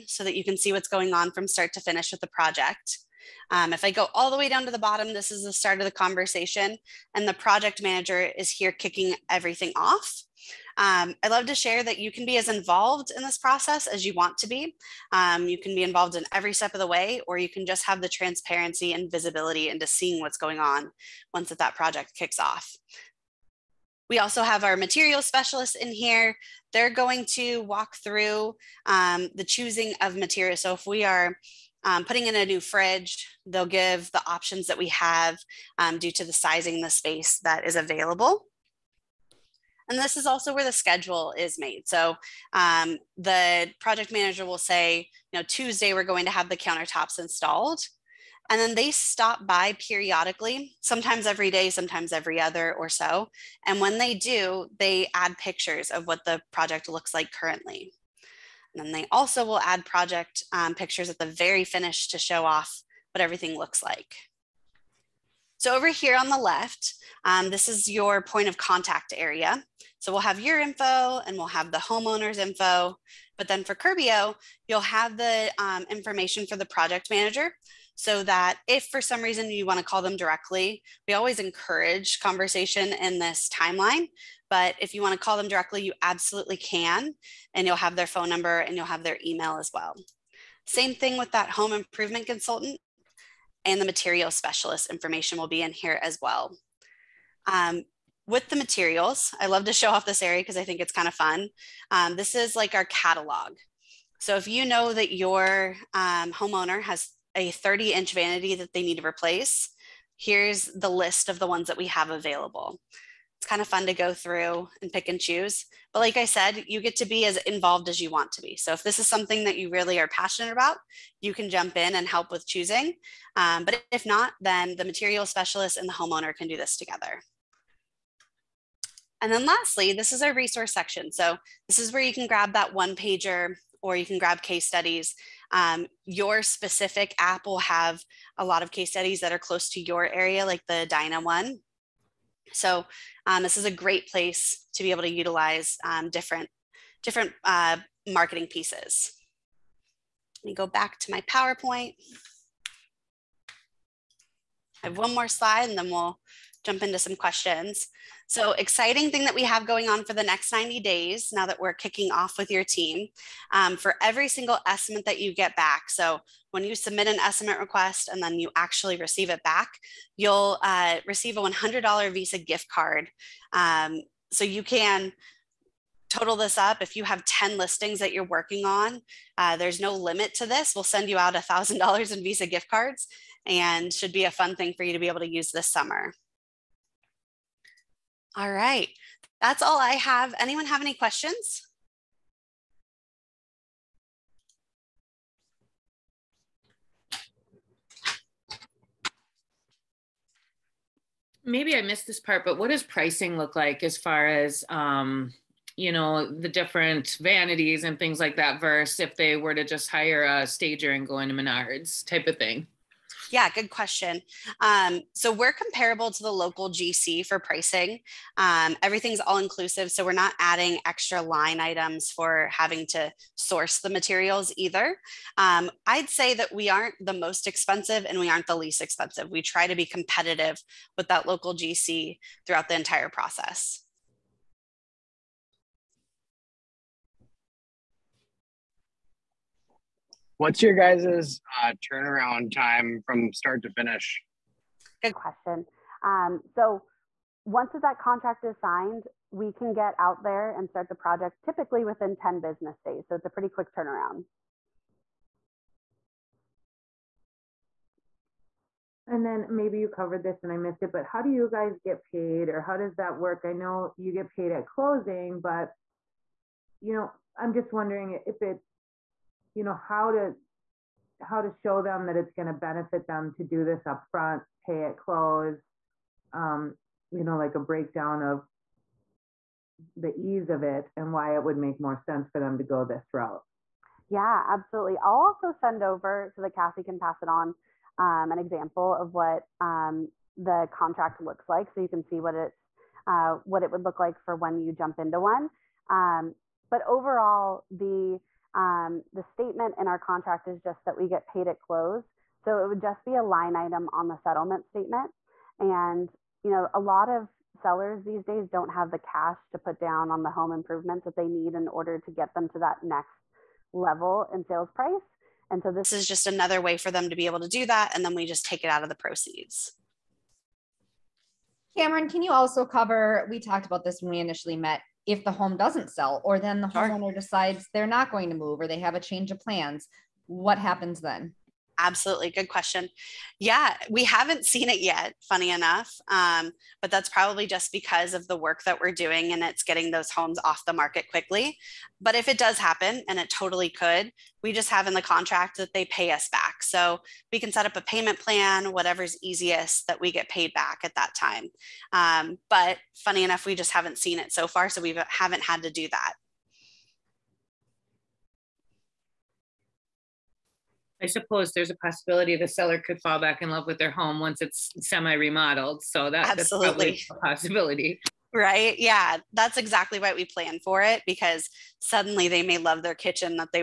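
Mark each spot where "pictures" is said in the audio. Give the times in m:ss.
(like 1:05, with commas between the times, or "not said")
0:55, 1:00.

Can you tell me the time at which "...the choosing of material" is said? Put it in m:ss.
0:29.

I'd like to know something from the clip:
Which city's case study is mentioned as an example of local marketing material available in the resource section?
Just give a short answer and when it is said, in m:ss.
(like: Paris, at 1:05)
Edina, at 2:20.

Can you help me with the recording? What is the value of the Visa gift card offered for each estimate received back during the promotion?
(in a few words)
$100.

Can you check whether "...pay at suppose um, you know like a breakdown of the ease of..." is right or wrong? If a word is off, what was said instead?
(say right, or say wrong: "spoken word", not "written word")
wrong: "close", not "suppose".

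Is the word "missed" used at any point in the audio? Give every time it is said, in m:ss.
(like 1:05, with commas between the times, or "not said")
3:21, 4:20.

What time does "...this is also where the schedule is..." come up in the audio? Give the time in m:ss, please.
0:39.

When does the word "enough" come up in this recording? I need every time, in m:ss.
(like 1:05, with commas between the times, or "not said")
5:35, 5:53.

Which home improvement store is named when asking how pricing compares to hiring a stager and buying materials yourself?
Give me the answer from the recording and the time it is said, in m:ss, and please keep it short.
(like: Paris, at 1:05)
Menards, at 3:31.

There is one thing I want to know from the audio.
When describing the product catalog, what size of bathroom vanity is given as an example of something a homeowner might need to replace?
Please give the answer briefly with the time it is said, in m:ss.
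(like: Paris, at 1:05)
30 inch, at 1:47.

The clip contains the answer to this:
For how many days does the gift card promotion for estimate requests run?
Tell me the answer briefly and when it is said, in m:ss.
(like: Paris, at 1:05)
90, at 2:40.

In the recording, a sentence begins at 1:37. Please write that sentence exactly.
Um, with the materials, I love to show off this area because I think it's kind of fun.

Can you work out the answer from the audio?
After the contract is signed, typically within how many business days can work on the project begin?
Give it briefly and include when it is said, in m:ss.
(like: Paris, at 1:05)
10, at 4:12.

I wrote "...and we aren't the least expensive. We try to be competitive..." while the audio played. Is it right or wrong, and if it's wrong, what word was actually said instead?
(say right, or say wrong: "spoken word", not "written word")
right.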